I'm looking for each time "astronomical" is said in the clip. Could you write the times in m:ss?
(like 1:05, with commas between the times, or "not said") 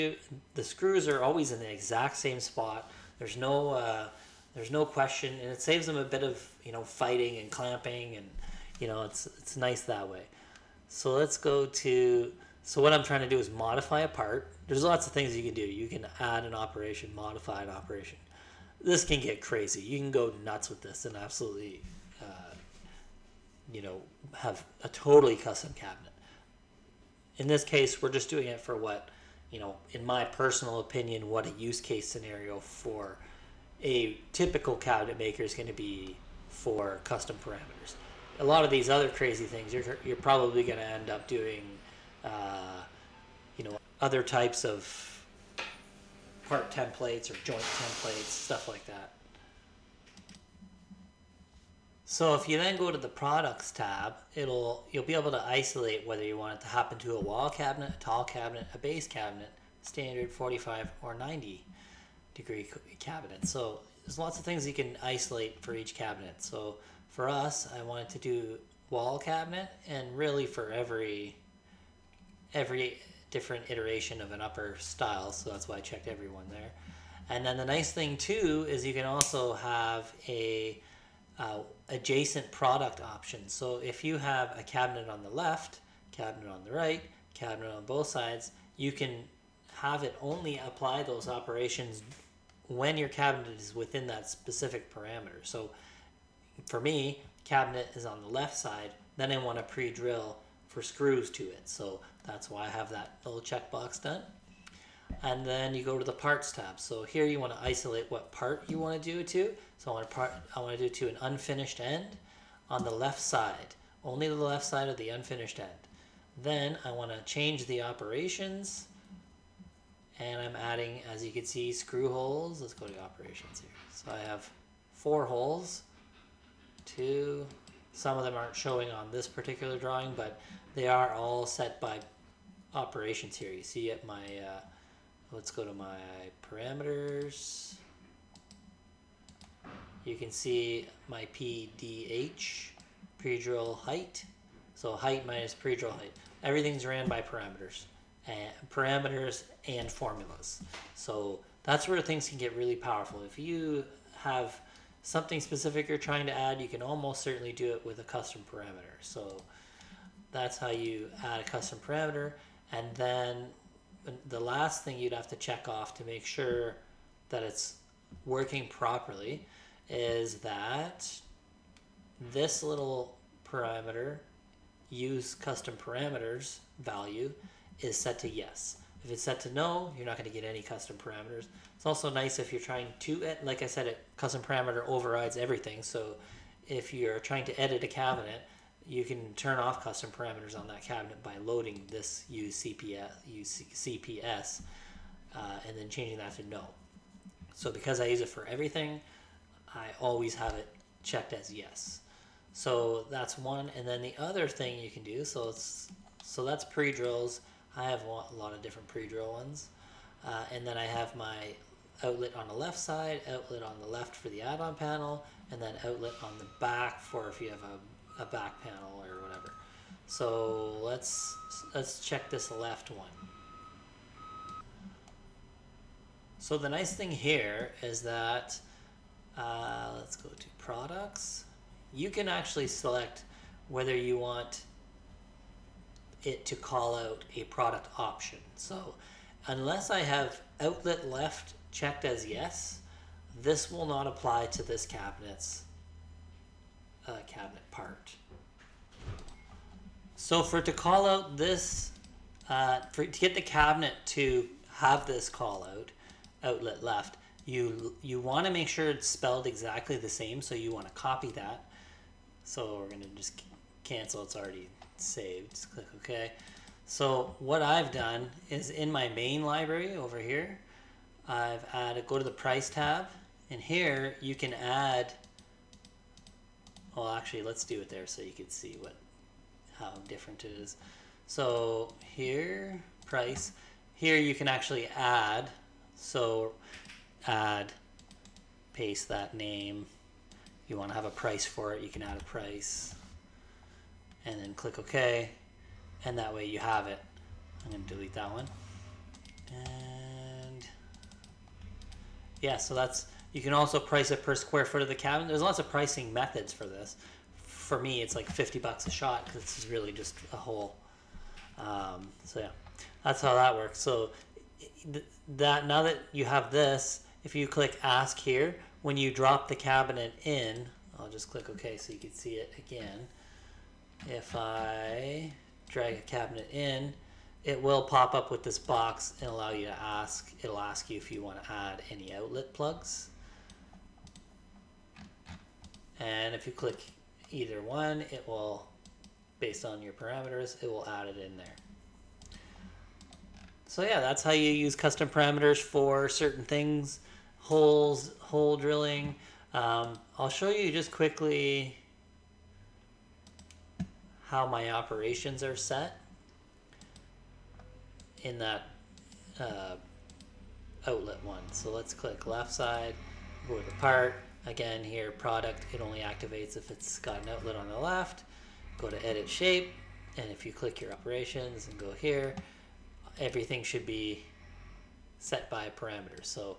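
not said.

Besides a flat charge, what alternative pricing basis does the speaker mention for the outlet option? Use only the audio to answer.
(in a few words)
per square foot.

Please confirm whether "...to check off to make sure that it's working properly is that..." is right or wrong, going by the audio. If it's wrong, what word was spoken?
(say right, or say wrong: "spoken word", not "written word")
right.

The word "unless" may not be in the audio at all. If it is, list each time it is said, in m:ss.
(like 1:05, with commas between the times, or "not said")
3:59.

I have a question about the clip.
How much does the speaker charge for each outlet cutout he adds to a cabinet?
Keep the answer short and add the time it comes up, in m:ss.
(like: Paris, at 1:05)
$50, at 5:08.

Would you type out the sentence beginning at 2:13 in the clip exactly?
You see at my, uh, let's go to my parameters.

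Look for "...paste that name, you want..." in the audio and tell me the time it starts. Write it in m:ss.
4:48.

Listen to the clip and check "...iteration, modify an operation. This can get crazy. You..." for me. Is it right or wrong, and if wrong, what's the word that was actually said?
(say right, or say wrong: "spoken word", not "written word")
wrong: "operation", not "iteration".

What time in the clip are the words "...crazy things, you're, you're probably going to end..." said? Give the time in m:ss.
0:39.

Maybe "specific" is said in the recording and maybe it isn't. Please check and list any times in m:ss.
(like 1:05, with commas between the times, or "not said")
1:34, 2:35.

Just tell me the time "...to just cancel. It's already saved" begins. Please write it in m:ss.
4:23.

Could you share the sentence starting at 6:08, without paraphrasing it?
Go to edit shape, and if you click your operations and go here, everything should be set by a parameter.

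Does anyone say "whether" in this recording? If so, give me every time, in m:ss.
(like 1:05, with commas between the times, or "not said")
0:56, 3:53.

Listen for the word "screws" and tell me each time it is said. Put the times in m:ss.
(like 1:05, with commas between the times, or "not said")
0:00, 1:40, 2:01.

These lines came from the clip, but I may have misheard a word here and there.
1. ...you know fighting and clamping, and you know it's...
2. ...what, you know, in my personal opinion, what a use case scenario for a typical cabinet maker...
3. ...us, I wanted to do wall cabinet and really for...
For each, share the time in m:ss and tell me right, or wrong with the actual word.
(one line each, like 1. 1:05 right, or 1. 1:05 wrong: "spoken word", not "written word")
1. 0:06 right
2. 0:28 right
3. 1:07 right.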